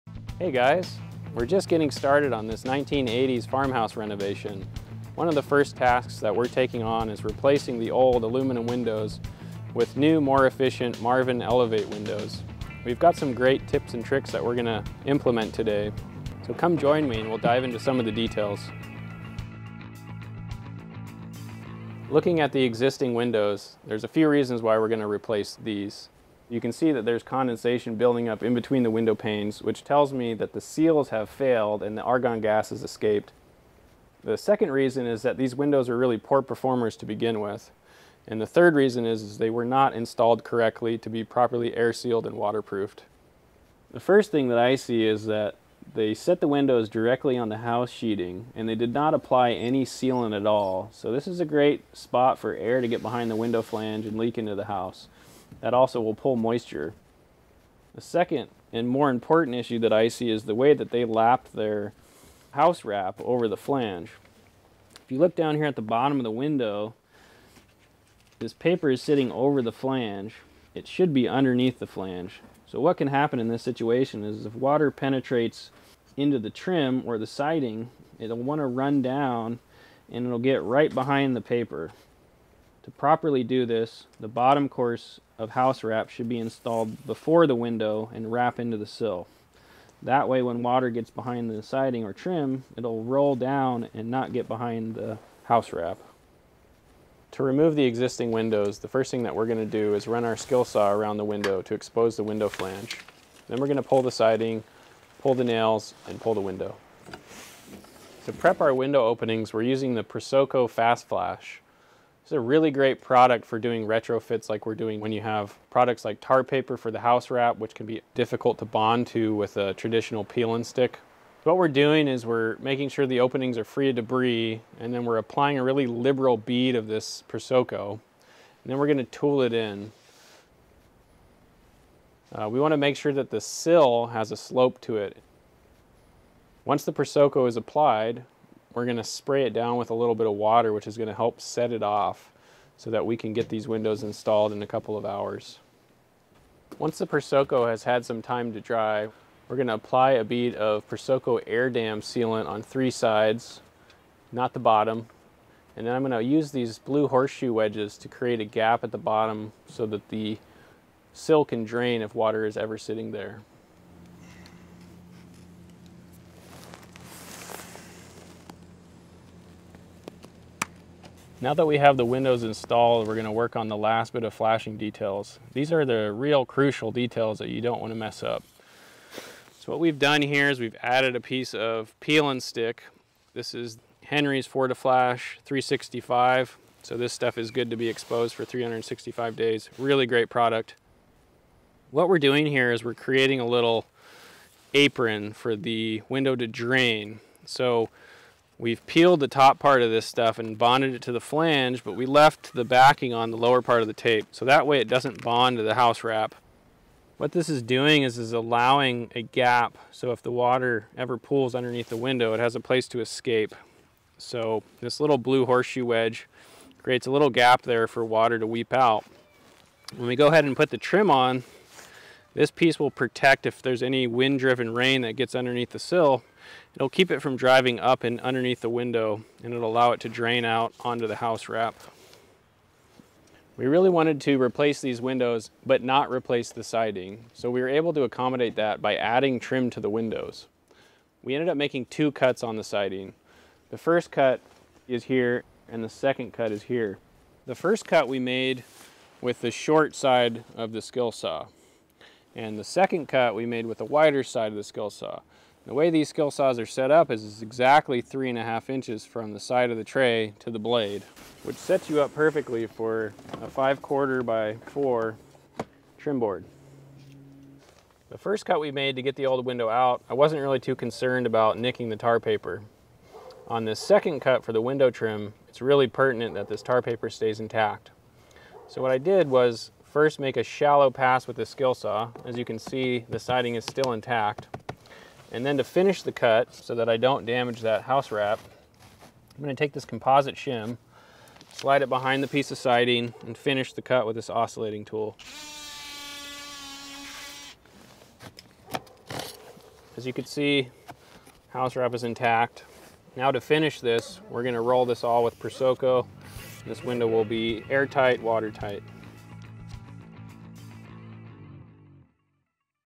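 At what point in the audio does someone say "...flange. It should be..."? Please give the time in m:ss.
1:09.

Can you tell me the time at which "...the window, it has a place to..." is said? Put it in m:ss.
3:31.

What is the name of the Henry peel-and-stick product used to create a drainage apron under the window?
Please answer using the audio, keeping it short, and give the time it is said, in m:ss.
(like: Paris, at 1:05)
Fortiflash 365, at 3:04.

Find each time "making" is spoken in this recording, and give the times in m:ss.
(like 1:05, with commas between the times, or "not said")
2:02, 4:01.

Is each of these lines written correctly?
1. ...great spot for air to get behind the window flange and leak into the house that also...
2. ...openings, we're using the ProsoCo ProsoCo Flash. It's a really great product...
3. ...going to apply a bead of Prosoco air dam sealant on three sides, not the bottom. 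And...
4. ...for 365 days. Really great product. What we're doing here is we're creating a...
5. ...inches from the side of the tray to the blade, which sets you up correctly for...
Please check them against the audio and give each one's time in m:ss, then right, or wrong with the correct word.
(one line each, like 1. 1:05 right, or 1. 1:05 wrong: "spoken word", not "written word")
1. 0:51 right
2. 1:49 wrong: "Fast", not "ProsoCo"
3. 2:29 right
4. 3:08 right
5. 4:18 wrong: "perfectly", not "correctly".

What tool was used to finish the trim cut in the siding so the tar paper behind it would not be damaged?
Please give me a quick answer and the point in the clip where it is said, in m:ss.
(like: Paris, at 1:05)
Oscillating tool, at 4:54.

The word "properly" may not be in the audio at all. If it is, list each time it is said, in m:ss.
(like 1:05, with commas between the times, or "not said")
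0:41, 1:22.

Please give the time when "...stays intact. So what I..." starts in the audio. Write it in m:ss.
4:37.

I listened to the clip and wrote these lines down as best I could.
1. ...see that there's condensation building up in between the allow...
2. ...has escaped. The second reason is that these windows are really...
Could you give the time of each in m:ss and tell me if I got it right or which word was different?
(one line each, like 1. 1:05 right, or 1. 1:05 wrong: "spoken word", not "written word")
1. 0:26 wrong: "window", not "allow"
2. 0:32 right.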